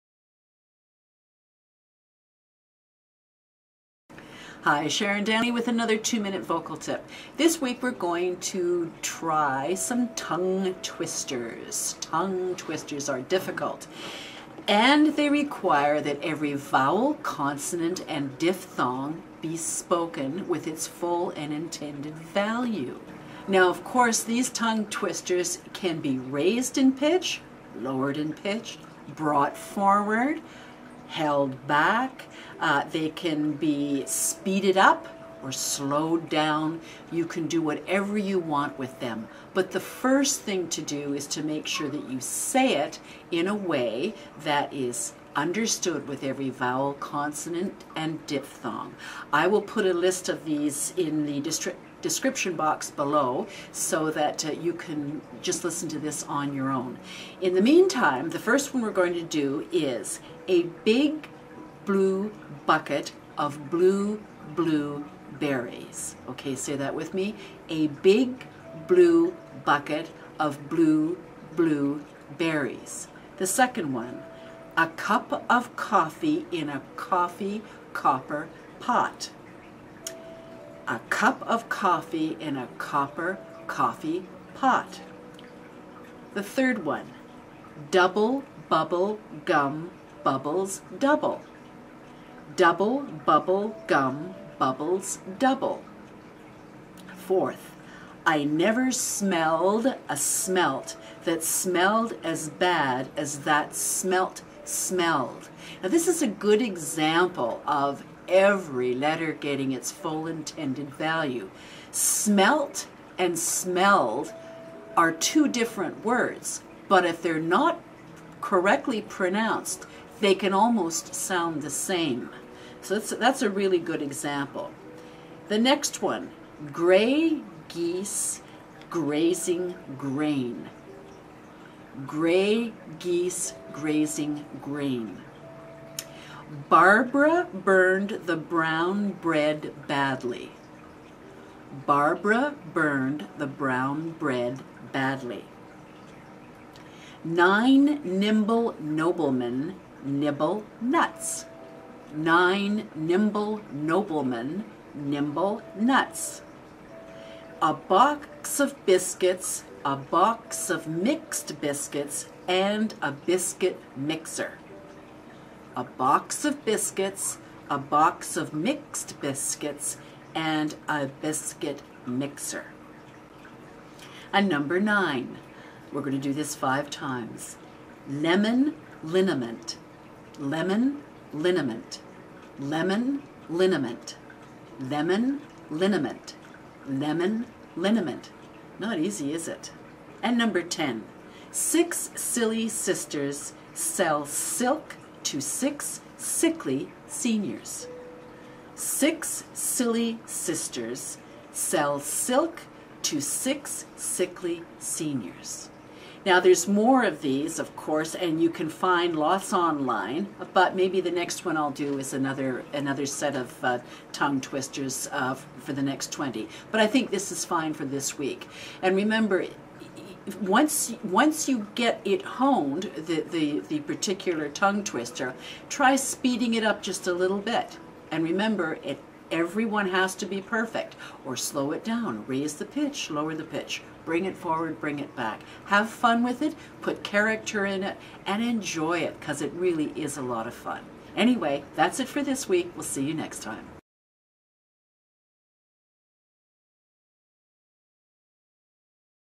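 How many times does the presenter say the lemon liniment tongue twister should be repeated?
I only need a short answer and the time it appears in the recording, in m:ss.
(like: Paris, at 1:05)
5, at 2:56.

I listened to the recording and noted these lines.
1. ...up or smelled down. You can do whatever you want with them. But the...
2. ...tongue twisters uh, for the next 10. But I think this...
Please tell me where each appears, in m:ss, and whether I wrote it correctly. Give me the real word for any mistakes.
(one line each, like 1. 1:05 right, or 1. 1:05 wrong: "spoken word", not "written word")
1. 0:34 wrong: "slowed", not "smelled"
2. 3:34 wrong: "20", not "10".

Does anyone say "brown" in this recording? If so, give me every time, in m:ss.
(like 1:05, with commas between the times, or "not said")
2:18, 2:23.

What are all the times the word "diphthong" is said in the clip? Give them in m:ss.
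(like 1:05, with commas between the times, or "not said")
0:18, 0:48.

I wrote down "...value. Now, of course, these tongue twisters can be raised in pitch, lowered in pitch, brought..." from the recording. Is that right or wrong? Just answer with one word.
right.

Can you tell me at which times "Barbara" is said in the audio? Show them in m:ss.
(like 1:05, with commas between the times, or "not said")
2:16, 2:21.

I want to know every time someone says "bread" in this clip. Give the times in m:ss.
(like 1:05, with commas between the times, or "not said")
2:19, 2:24.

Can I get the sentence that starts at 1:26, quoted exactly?
The third one, double bubble gum bubbles double double, bubble, gum, bubbles, double.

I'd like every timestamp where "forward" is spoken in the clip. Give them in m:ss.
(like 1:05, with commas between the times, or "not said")
0:29, 3:54.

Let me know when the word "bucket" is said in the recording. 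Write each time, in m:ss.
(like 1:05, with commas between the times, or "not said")
1:02, 1:09.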